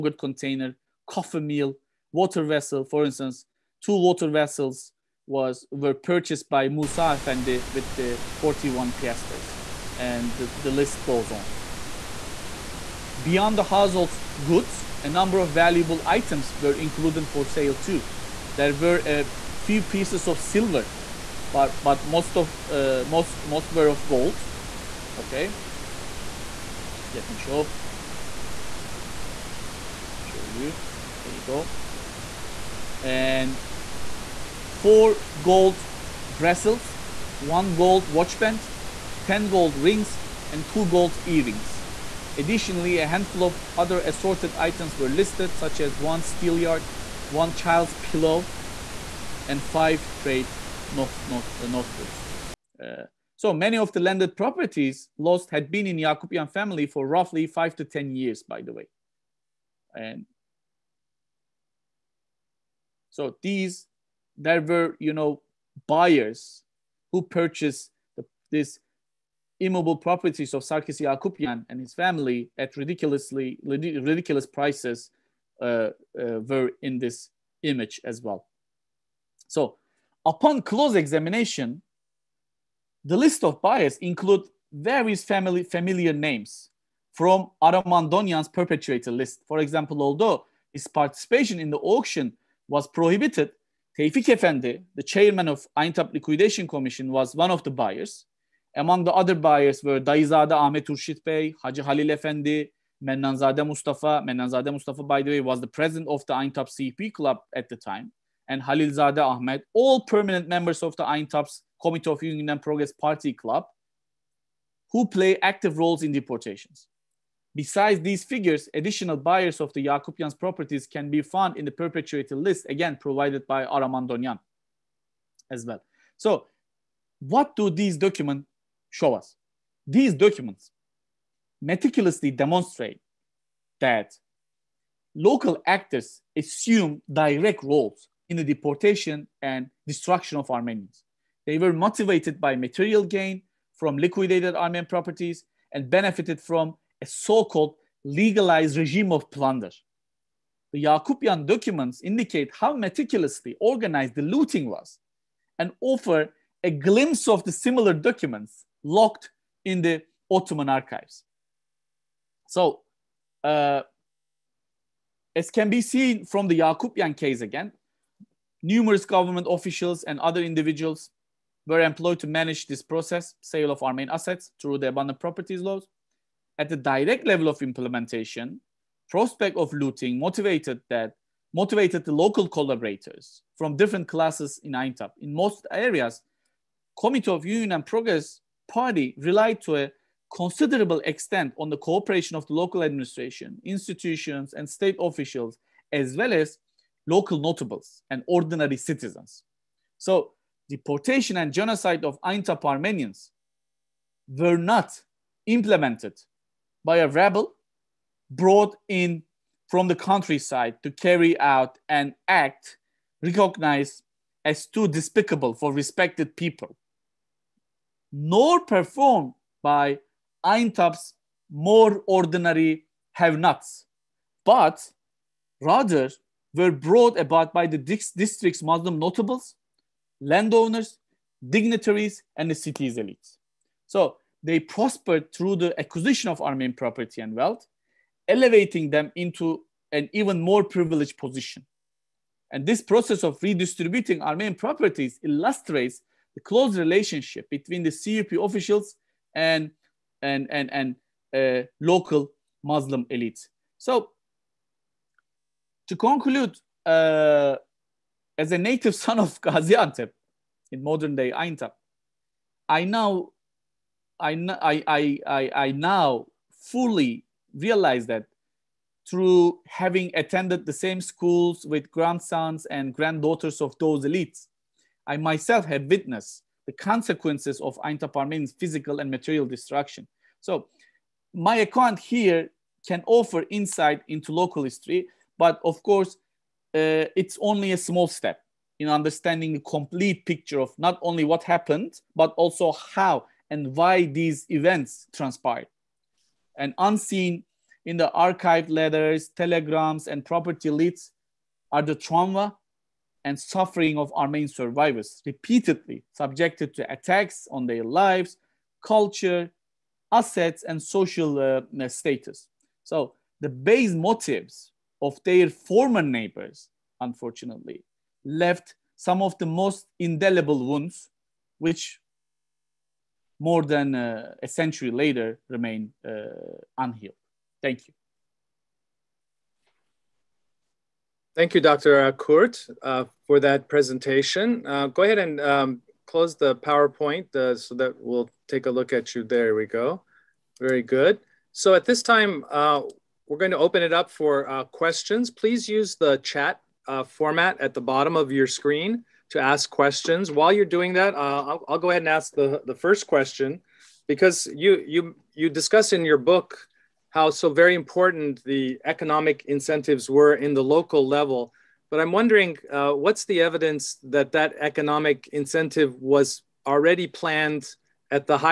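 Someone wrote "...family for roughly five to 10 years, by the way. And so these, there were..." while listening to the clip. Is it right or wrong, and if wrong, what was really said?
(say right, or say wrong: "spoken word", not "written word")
right.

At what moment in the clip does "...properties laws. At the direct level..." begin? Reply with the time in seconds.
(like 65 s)
175 s.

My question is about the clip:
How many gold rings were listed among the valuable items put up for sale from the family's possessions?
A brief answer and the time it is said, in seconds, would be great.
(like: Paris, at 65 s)
10, at 39 s.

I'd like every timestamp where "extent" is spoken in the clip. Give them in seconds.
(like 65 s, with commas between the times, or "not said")
191 s.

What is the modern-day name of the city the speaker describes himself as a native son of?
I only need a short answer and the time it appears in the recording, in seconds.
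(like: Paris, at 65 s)
Gaziantep, at 259 s.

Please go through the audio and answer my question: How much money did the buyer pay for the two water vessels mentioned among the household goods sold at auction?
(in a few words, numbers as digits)
41 piasters.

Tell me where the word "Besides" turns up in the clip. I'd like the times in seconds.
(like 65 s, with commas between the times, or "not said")
117 s.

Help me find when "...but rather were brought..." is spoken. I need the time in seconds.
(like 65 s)
224 s.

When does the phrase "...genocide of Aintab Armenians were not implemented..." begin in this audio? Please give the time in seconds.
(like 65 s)
201 s.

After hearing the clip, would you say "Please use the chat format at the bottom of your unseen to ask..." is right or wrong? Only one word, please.
wrong.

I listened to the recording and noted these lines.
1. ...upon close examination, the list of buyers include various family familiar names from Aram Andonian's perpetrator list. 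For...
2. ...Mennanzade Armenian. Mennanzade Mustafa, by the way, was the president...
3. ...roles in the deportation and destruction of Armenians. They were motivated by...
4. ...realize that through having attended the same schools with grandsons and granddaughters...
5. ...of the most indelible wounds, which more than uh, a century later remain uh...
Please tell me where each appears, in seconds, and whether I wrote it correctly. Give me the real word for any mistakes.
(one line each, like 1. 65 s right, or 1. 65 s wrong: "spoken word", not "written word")
1. 80 s right
2. 103 s wrong: "Mustafa", not "Armenian"
3. 137 s right
4. 267 s right
5. 319 s right.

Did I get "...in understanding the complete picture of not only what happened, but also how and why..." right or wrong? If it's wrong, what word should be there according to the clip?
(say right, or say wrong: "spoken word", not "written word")
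right.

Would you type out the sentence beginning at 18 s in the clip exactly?
There were a few pieces of silver, but, but most of uh, most most were of gold.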